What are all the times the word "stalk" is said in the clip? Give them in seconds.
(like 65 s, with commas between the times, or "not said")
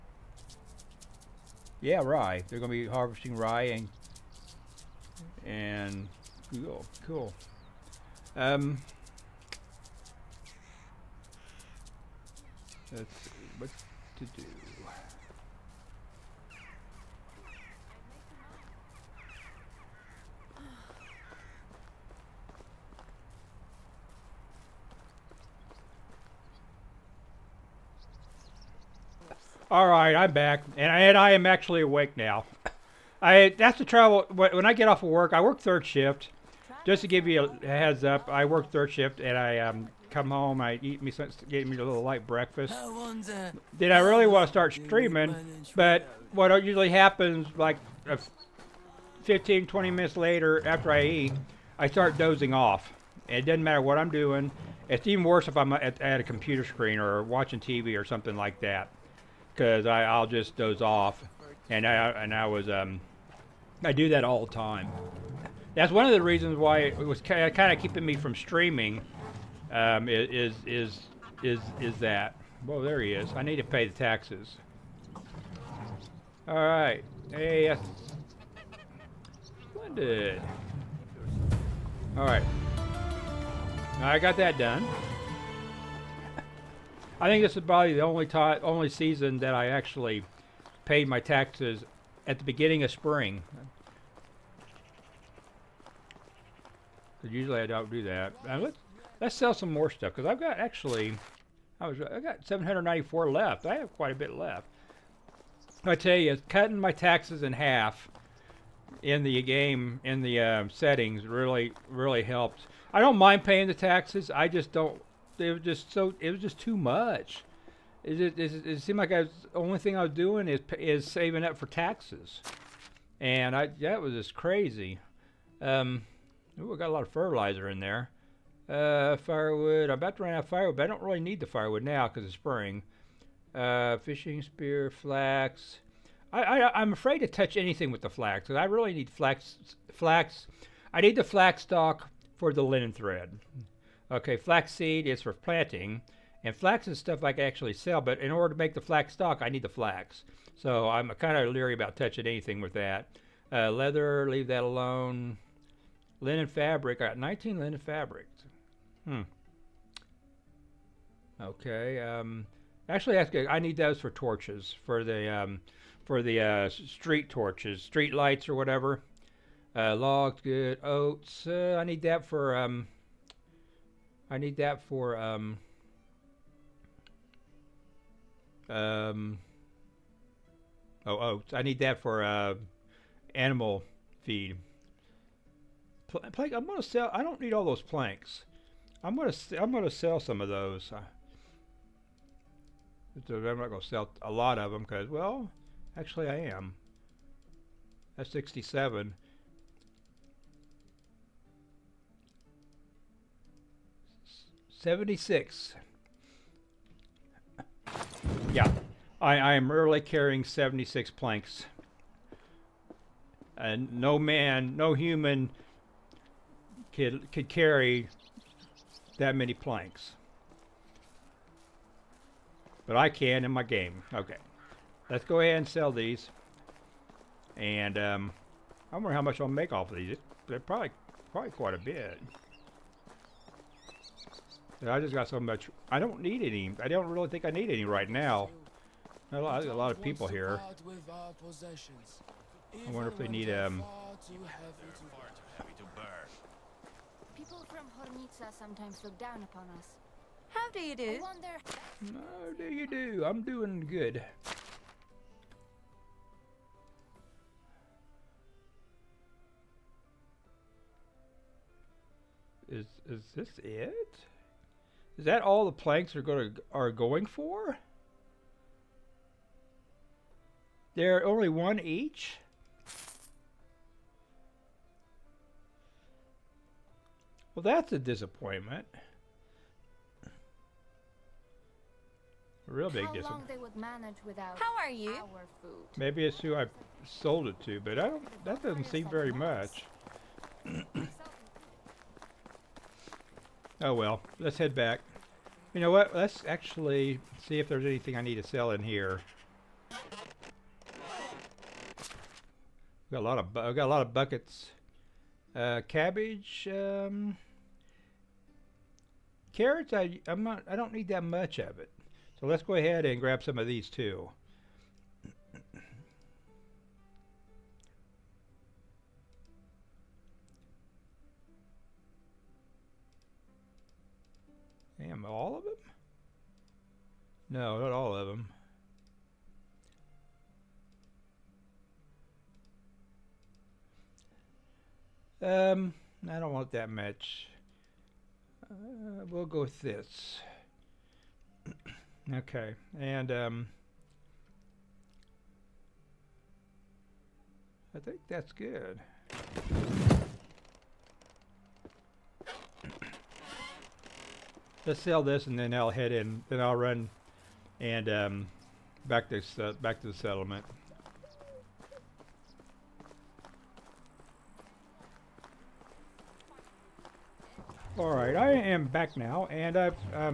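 141 s, 149 s.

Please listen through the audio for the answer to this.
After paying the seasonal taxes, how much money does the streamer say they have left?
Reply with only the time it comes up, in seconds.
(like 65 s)
102 s.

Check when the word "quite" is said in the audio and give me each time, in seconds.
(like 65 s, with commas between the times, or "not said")
103 s, 231 s.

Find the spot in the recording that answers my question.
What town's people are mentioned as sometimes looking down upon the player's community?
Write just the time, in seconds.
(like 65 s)
247 s.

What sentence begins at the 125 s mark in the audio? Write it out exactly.
Um, ooh, I got a lot of fertilizer in there.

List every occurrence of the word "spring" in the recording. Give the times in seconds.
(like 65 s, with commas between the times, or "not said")
92 s, 132 s.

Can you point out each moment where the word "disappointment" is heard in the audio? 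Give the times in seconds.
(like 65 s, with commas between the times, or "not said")
277 s, 283 s.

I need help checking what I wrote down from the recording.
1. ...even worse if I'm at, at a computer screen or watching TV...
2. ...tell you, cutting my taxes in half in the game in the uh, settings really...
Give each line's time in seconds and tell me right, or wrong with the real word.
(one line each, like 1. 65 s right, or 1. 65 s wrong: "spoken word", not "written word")
1. 55 s right
2. 105 s right.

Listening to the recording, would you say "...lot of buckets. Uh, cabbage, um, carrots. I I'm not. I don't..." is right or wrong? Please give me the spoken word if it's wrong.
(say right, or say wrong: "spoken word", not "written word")
right.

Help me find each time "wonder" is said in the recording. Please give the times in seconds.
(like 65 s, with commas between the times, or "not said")
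228 s, 242 s.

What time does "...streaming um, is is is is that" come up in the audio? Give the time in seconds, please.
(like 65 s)
68 s.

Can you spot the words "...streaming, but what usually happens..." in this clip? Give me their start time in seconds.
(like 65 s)
44 s.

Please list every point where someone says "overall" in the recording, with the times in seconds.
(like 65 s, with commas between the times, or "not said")
not said.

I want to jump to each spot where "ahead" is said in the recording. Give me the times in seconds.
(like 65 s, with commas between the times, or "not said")
225 s, 312 s.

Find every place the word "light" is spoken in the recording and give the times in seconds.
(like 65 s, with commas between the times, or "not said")
42 s, 168 s.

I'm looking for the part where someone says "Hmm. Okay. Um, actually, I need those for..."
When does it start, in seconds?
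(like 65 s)
159 s.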